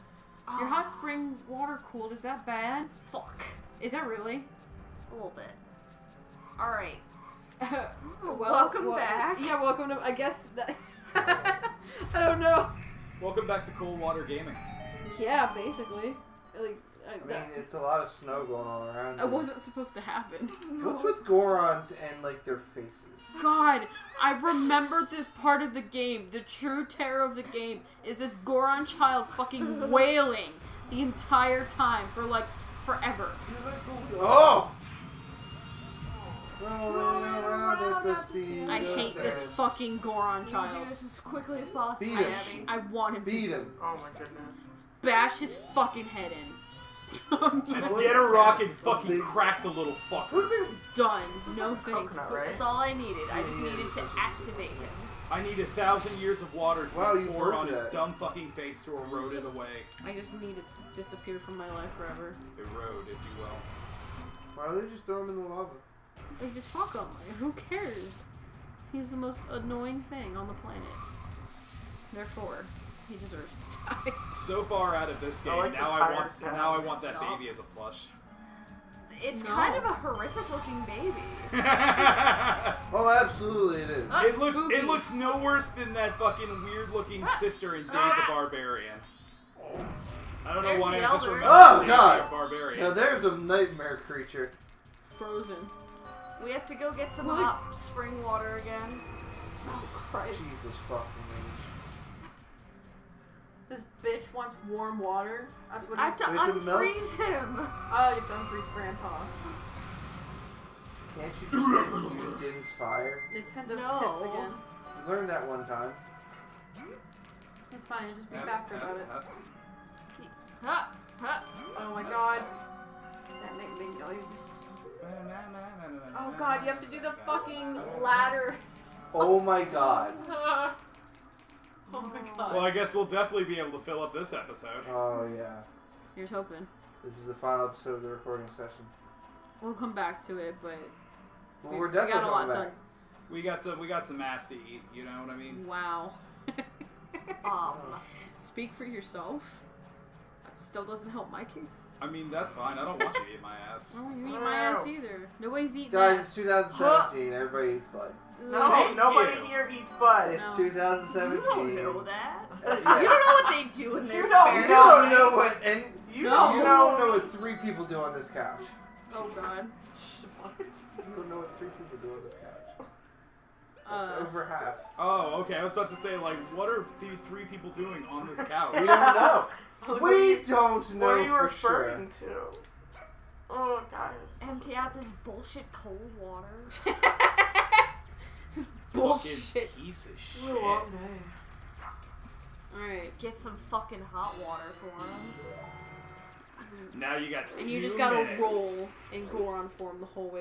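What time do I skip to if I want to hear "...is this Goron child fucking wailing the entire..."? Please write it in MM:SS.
00:28.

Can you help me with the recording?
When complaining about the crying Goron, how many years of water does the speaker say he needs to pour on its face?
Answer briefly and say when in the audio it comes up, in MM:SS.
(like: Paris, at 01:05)
1000, at 00:55.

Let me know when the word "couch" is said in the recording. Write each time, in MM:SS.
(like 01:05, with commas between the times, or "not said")
02:48, 02:52, 02:58.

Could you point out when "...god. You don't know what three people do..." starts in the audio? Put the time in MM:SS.
02:49.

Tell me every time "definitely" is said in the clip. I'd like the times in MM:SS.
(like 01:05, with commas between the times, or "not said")
02:13, 02:21.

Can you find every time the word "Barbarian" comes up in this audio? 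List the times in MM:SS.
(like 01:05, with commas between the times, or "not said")
01:28, 01:32.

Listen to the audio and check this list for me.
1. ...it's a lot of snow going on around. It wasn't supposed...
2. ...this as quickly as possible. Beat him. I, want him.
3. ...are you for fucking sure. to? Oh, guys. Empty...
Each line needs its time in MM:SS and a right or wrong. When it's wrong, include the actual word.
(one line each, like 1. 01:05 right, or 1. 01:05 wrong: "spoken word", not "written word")
1. 00:17 right
2. 00:40 right
3. 03:01 wrong: "referring", not "fucking".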